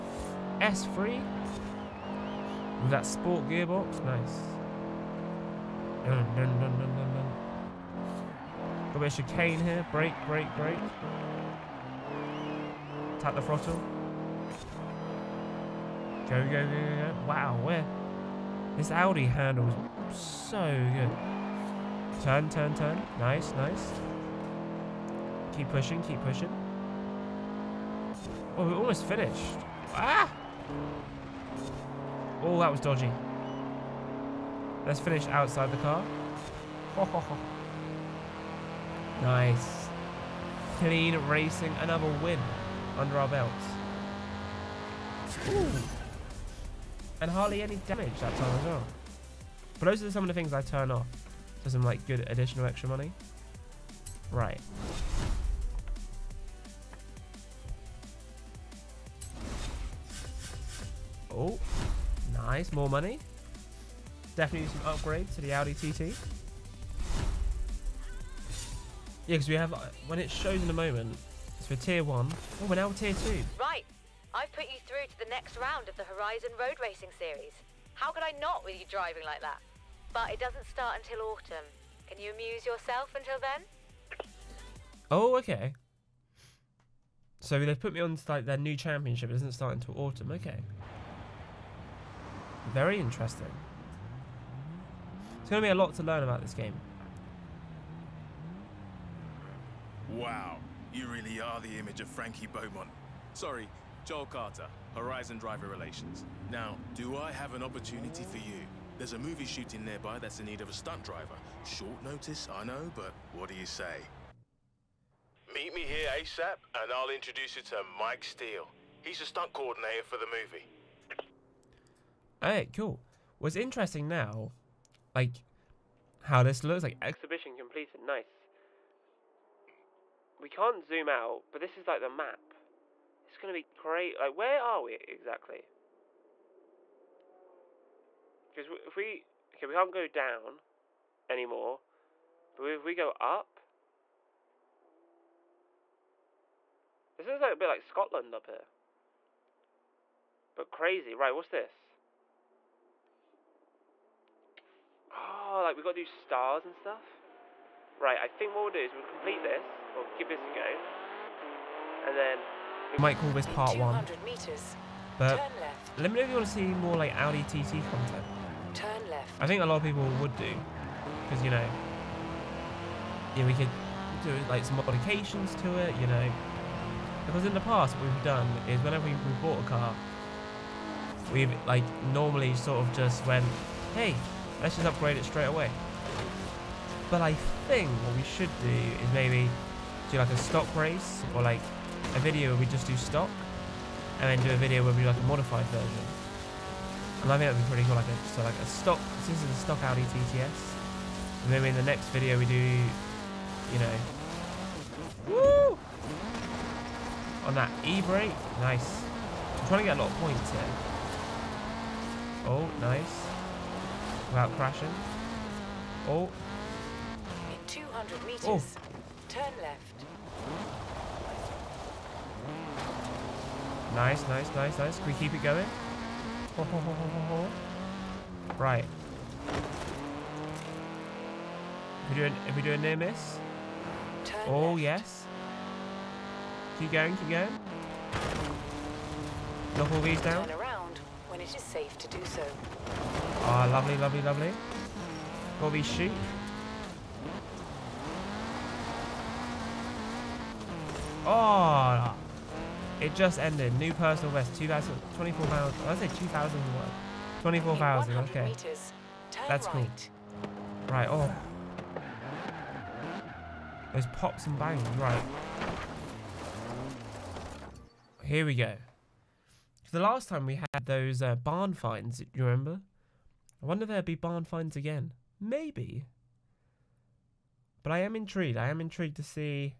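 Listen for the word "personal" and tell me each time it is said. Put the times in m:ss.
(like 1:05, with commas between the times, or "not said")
4:13.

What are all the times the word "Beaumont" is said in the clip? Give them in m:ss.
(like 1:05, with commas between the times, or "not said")
1:42.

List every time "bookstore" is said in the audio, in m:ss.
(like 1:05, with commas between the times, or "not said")
not said.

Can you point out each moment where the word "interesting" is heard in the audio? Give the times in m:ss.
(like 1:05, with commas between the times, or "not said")
1:32, 2:03.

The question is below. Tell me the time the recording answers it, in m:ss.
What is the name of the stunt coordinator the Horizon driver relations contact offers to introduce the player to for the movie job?
1:57.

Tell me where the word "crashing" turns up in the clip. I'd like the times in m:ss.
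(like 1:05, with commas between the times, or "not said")
3:34.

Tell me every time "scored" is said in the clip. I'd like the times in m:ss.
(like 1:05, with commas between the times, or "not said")
not said.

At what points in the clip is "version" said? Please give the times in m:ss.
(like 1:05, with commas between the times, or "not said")
3:15.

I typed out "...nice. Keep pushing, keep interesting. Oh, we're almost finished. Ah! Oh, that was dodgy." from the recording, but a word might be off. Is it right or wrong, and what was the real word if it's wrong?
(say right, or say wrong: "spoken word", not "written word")
wrong: "pushing", not "interesting".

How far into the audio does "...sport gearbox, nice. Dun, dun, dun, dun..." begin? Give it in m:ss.
0:03.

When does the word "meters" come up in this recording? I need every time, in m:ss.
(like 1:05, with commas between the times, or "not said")
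2:44, 3:38, 4:18.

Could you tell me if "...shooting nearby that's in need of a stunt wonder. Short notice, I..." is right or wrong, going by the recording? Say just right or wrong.
wrong.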